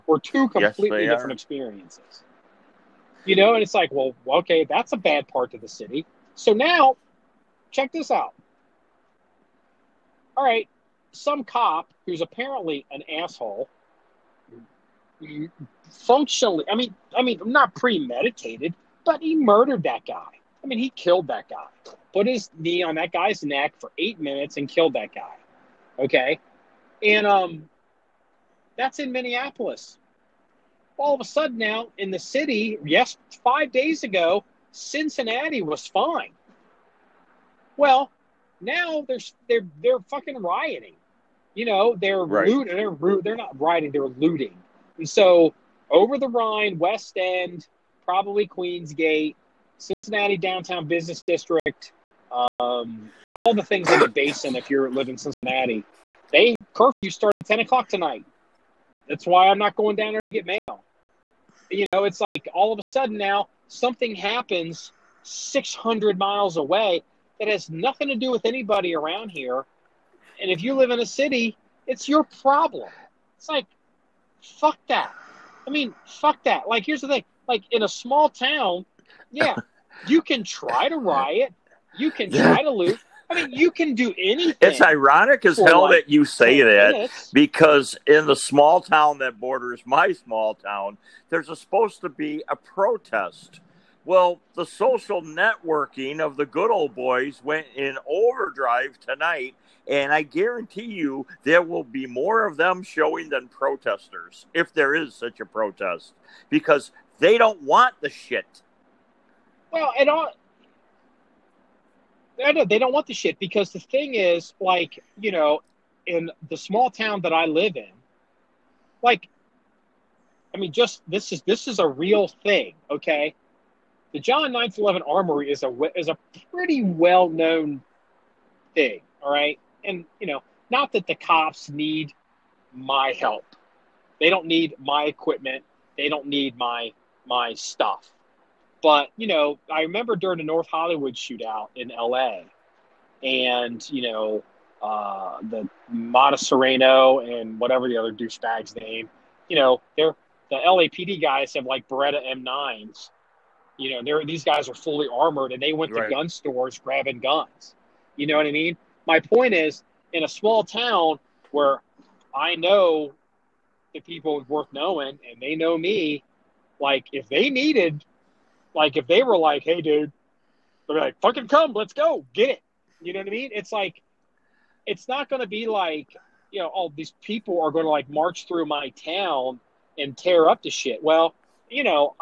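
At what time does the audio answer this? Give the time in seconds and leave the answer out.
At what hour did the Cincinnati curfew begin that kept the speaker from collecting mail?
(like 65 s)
57 s.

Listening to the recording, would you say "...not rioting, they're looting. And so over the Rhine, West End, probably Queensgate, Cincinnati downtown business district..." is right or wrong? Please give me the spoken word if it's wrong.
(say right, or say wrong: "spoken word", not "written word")
right.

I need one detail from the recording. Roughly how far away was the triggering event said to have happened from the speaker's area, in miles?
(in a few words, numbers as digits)
600.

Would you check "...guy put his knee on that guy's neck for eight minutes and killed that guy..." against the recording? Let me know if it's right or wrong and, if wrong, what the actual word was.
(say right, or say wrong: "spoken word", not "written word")
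right.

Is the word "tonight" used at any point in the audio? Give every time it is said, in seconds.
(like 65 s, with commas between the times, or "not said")
57 s, 99 s.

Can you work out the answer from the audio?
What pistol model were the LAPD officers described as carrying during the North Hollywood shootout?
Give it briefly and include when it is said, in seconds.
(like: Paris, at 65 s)
Beretta M9, at 151 s.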